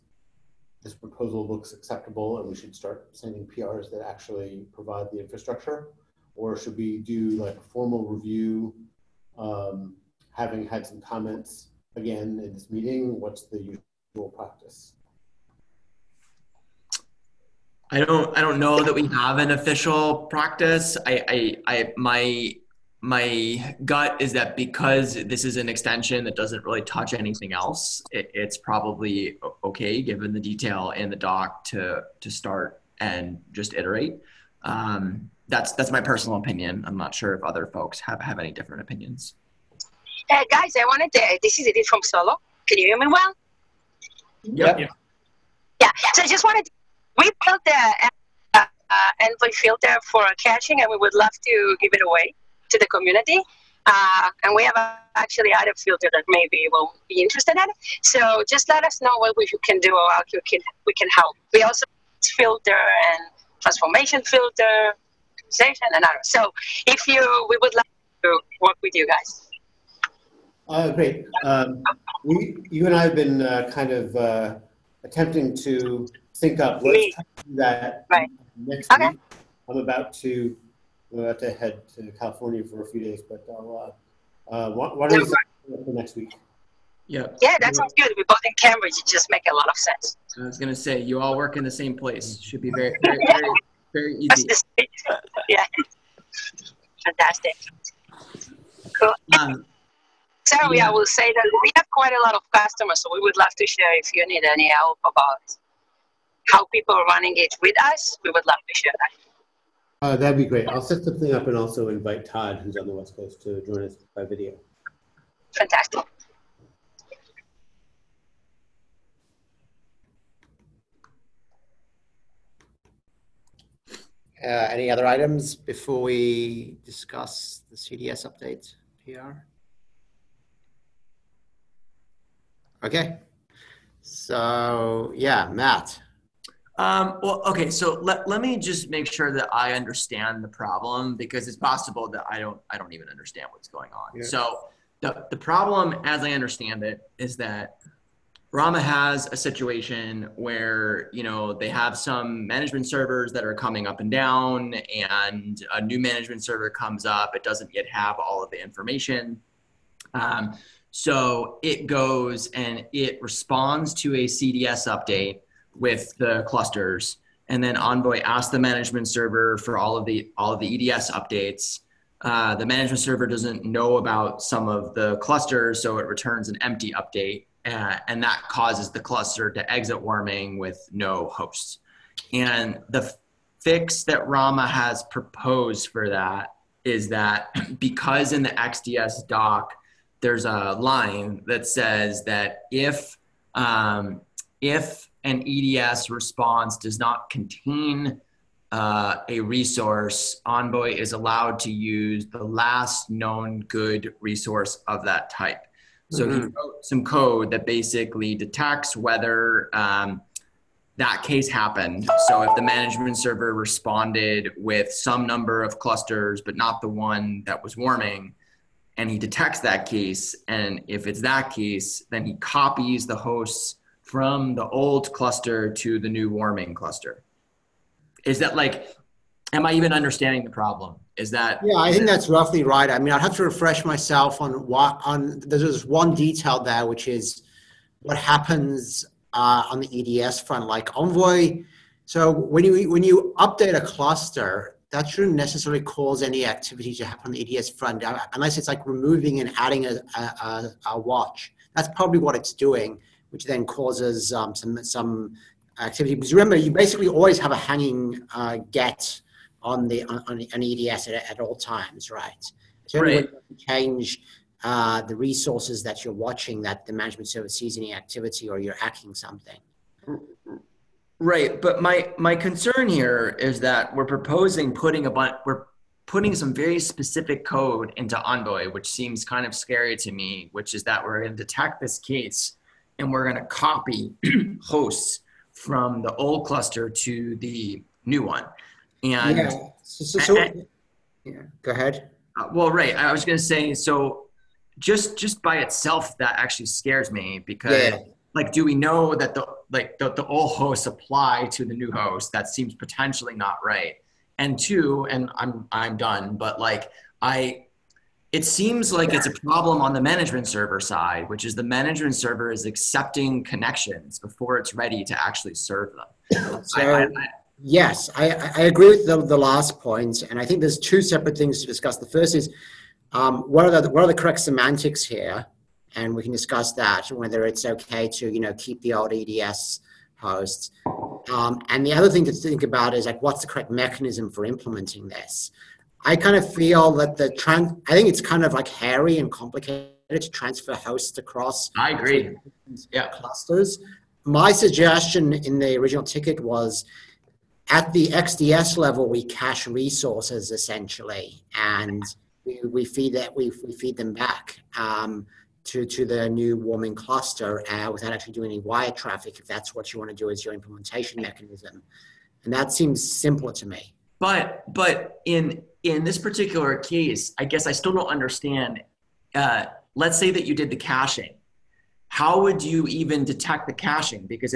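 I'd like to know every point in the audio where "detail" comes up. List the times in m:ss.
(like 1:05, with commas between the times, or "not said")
0:30, 3:56.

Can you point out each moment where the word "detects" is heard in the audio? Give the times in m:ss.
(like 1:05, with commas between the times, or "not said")
3:28, 3:39, 4:41, 6:13.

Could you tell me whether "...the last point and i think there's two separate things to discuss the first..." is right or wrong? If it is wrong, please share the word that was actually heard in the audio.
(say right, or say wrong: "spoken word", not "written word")
right.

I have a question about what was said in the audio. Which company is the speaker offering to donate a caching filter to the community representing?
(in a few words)
Solo.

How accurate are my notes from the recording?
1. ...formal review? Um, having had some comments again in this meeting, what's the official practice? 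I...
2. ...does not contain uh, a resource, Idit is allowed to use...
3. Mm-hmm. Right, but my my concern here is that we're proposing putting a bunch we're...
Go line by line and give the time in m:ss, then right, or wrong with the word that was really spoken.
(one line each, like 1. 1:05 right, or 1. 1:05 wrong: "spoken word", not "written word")
1. 0:07 wrong: "usual", not "official"
2. 3:16 wrong: "Envoy", not "Idit"
3. 4:30 right.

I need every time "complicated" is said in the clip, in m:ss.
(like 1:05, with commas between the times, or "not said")
5:39.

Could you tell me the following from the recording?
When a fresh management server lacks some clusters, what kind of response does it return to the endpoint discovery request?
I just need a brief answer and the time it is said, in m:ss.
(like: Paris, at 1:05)
empty update, at 2:56.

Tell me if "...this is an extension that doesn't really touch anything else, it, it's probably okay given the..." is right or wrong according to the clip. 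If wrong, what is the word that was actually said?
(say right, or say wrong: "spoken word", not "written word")
right.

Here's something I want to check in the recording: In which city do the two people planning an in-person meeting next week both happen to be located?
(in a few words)
Cambridge.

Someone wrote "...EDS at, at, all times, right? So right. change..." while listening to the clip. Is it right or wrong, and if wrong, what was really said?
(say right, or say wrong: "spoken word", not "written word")
right.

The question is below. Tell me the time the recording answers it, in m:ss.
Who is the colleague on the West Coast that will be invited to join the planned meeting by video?
1:52.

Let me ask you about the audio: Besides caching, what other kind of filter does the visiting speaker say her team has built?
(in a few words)
transformation filter.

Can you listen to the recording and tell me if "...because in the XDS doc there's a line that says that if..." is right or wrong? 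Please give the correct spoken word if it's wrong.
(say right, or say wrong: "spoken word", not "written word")
right.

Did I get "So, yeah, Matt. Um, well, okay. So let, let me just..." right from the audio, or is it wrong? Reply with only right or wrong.
right.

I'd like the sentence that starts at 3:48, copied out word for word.
Is that like, am I even understanding the problem?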